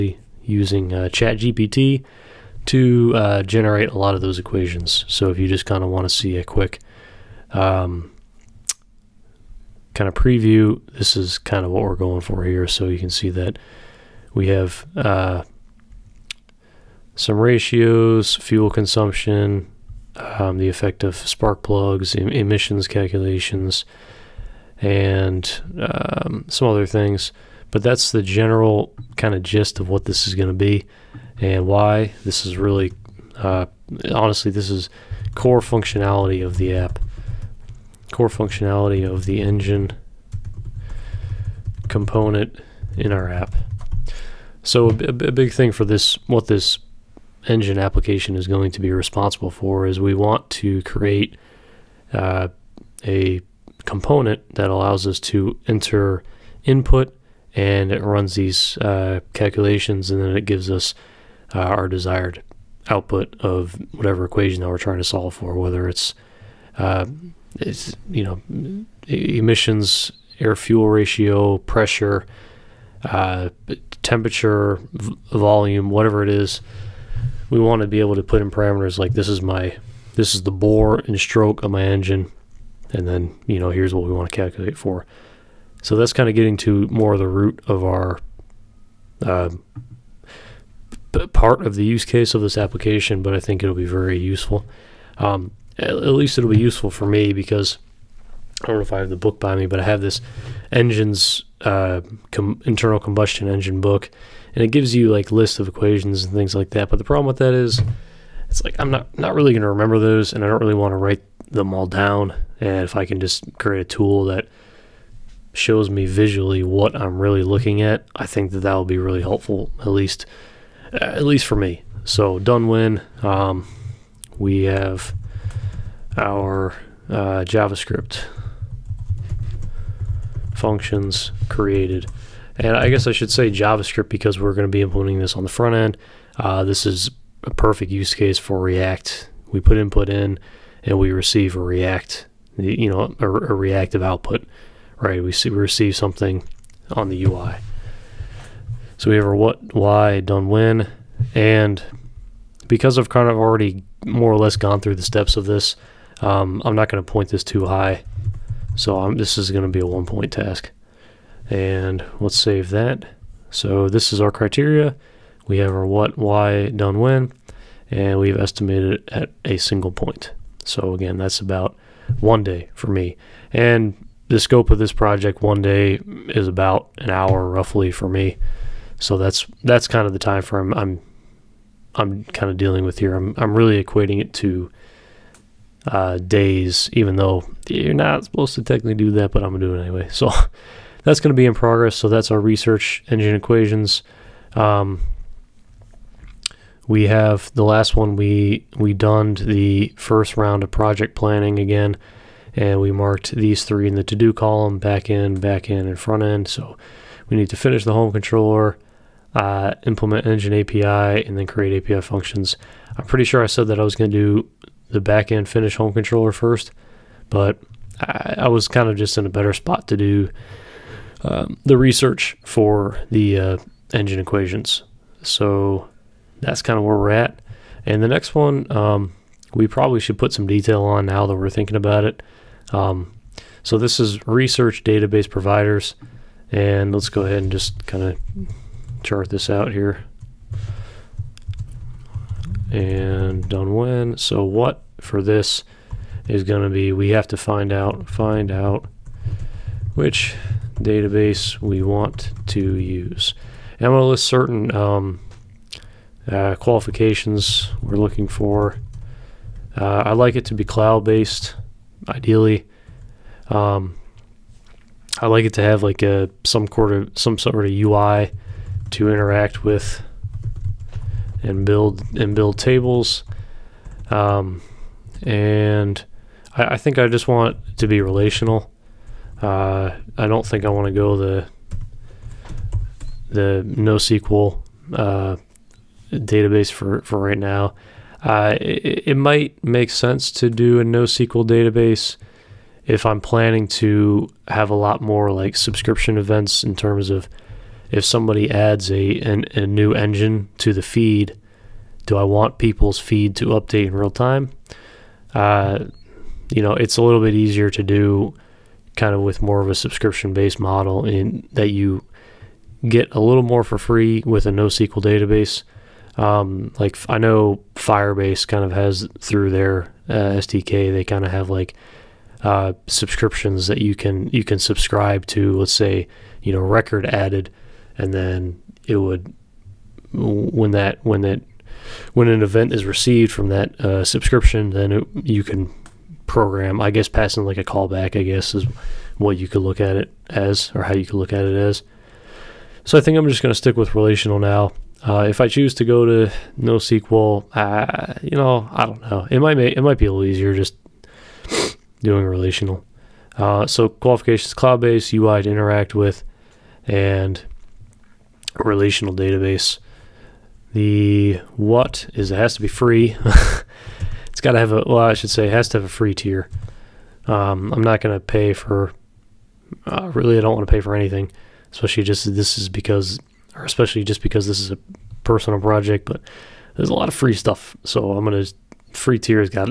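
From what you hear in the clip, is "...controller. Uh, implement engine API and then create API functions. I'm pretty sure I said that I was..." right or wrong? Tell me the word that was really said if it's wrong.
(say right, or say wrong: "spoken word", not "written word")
right.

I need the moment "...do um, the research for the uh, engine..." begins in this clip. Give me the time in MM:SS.
03:39.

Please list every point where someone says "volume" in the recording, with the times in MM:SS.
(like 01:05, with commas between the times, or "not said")
01:15.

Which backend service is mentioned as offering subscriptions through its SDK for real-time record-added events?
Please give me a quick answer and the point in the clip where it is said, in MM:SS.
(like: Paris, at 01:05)
Firebase, at 05:17.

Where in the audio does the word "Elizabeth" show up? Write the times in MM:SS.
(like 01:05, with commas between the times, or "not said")
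not said.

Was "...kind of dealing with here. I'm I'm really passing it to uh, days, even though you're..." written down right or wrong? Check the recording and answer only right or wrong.
wrong.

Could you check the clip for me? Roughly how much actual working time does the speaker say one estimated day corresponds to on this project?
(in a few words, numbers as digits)
an hour.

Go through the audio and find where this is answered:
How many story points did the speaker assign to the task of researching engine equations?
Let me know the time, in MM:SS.
02:39.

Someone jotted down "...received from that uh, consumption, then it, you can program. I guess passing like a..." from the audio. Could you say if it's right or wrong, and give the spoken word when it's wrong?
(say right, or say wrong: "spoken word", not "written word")
wrong: "subscription", not "consumption".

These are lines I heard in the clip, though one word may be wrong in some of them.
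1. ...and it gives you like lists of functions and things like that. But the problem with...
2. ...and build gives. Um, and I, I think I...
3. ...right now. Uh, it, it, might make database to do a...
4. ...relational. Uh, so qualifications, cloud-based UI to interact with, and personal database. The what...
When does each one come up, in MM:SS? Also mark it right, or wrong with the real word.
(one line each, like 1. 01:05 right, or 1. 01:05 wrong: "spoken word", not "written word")
1. 01:44 wrong: "equations", not "functions"
2. 04:32 wrong: "tables", not "gives"
3. 04:47 wrong: "sense", not "database"
4. 05:52 wrong: "relational", not "personal".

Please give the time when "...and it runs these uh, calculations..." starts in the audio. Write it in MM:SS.
00:57.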